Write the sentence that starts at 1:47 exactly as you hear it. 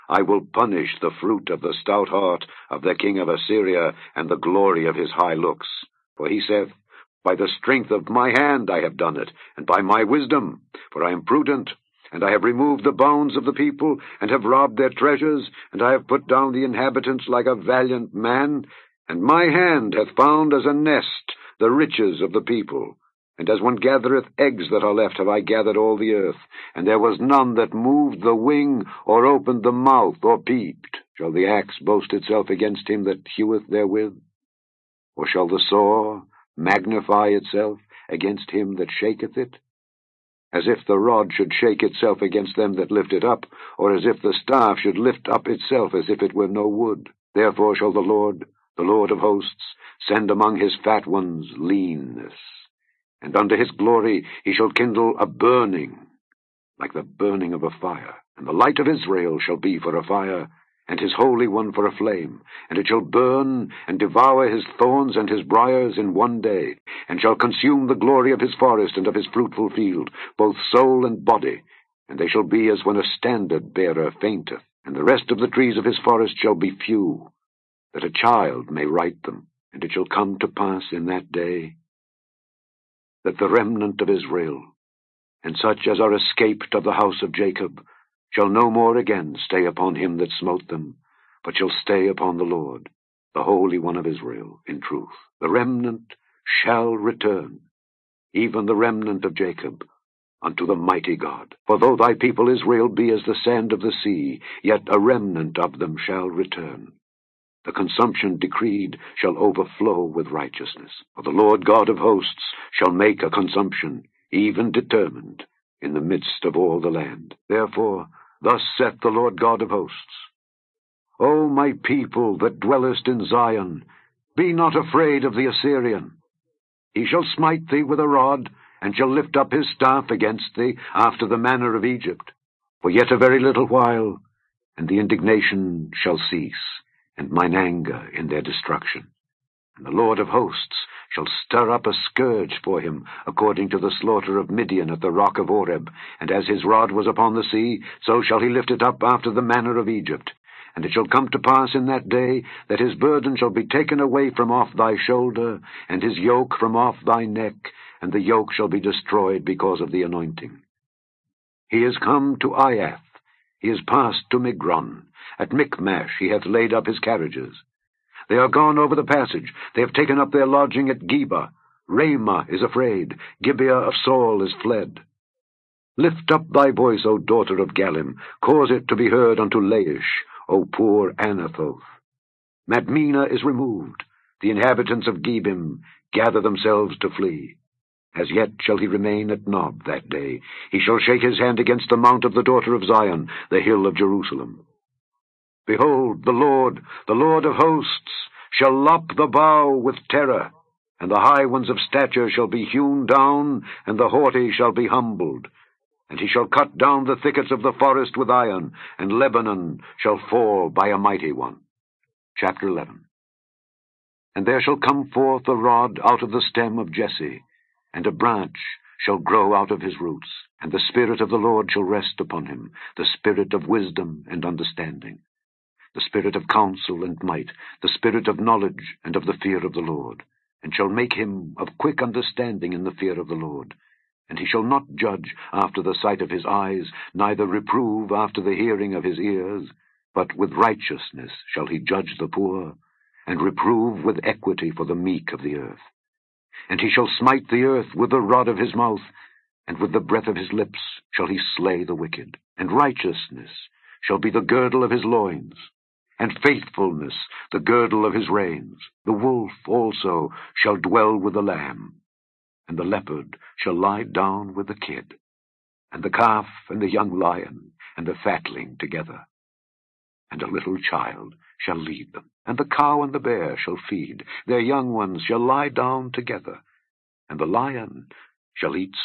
The consumption decreed shall overflow with righteousness.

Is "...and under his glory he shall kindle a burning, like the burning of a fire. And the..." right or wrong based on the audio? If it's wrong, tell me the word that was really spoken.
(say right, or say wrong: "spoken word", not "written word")
right.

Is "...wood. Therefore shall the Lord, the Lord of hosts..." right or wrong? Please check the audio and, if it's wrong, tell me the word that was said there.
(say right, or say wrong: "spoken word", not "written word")
right.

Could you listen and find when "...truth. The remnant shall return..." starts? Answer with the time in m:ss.
1:34.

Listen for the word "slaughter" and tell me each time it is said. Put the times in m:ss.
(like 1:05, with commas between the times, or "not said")
2:23.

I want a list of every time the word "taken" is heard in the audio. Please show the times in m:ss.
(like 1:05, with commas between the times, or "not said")
2:33, 2:49.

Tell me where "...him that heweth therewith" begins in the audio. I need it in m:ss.
0:32.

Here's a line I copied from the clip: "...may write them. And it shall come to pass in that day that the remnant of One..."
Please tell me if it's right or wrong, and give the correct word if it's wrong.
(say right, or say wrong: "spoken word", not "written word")
wrong: "Israel", not "One".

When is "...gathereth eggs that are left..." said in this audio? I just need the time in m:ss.
0:23.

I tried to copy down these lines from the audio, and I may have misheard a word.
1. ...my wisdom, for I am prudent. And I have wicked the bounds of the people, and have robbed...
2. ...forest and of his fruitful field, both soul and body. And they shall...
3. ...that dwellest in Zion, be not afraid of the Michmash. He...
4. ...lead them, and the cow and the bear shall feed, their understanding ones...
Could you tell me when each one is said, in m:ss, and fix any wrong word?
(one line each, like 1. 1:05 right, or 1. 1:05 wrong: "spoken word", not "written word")
1. 0:09 wrong: "removed", not "wicked"
2. 1:08 right
3. 2:02 wrong: "Assyrian", not "Michmash"
4. 4:31 wrong: "young", not "understanding".